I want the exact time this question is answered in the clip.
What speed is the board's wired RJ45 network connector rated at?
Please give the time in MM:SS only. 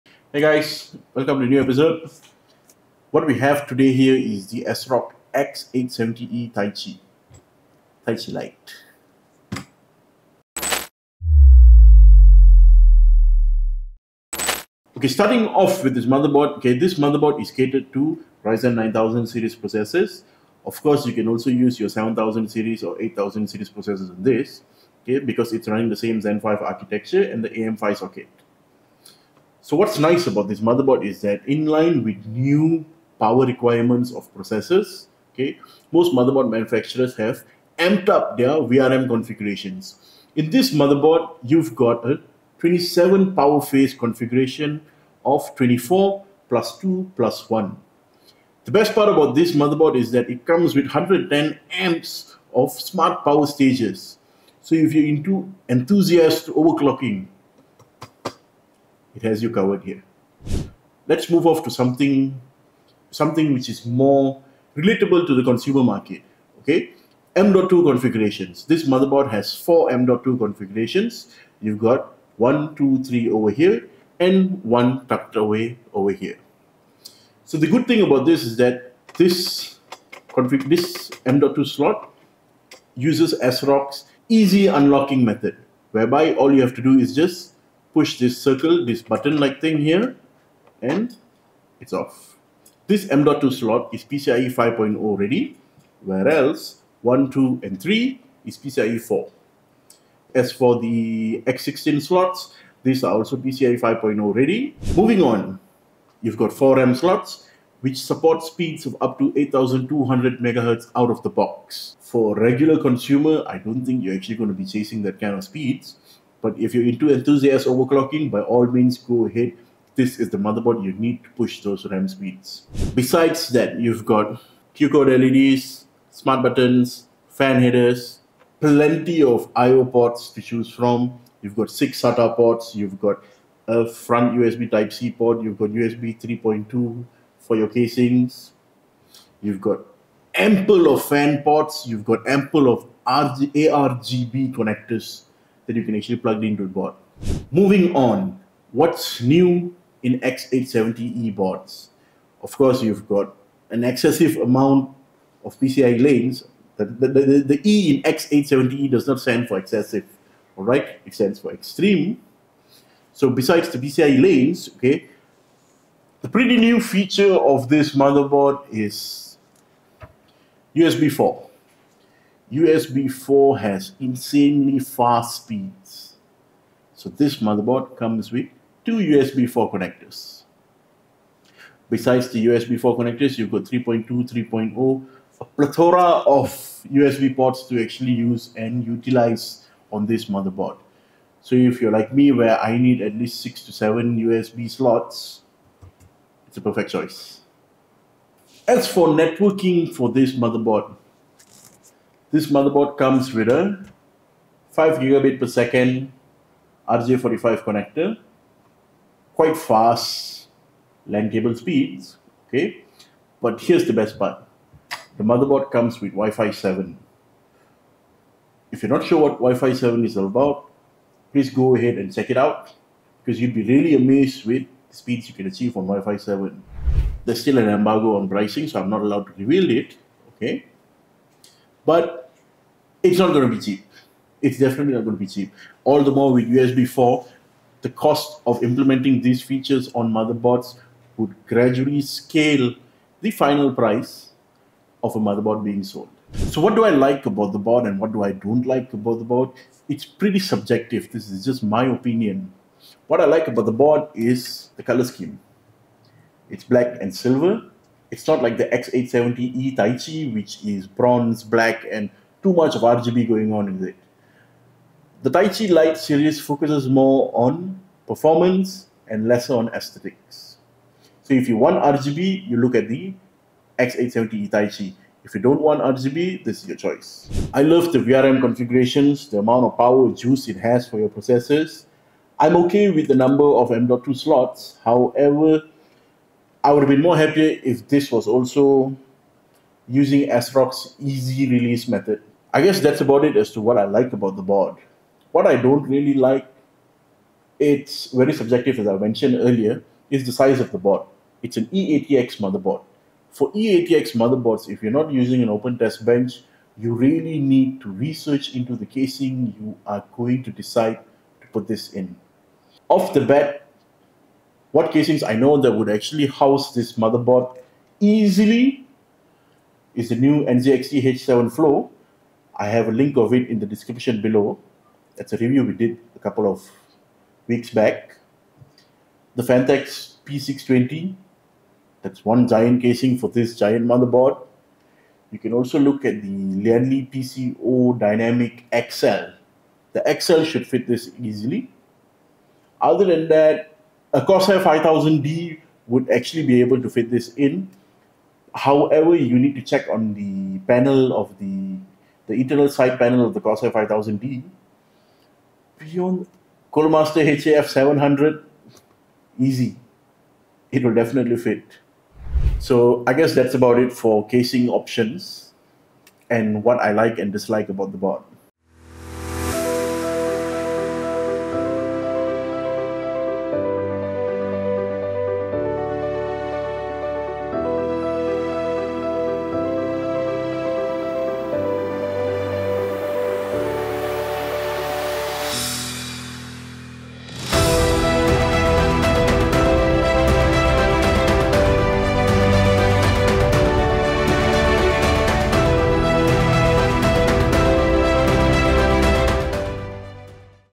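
03:24.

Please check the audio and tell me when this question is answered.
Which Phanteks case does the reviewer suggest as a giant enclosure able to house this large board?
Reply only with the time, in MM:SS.
05:29.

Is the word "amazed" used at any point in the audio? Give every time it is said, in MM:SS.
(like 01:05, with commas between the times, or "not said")
03:43.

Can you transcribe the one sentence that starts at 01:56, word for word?
But if you're into enthusiast overclocking, by all means go ahead.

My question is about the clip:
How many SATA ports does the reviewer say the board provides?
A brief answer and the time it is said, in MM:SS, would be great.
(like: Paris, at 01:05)
6, at 02:11.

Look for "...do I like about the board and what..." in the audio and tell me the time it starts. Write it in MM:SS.
04:06.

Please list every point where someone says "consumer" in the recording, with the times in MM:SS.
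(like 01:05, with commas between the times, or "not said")
01:05, 01:52.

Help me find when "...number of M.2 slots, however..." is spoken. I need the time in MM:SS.
04:43.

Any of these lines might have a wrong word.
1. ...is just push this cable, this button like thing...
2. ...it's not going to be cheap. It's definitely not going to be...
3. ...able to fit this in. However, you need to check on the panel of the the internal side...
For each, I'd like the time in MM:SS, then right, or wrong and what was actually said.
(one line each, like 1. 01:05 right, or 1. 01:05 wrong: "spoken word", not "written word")
1. 01:26 wrong: "circle", not "cable"
2. 03:53 right
3. 05:46 right.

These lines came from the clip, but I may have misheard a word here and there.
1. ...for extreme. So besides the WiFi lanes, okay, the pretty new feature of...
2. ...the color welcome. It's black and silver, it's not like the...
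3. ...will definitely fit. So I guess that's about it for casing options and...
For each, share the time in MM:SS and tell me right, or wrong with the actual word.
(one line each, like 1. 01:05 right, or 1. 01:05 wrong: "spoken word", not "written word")
1. 02:41 wrong: "PCI", not "WiFi"
2. 04:14 wrong: "scheme", not "welcome"
3. 06:00 right.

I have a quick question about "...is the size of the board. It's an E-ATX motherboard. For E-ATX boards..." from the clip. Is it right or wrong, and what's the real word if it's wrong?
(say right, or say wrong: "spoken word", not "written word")
wrong: "motherboards", not "boards".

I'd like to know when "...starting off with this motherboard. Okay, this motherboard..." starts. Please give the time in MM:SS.
00:15.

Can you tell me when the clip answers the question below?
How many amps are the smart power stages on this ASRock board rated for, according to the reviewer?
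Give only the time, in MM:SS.
00:50.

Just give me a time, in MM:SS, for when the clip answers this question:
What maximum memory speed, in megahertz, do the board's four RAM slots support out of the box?
01:49.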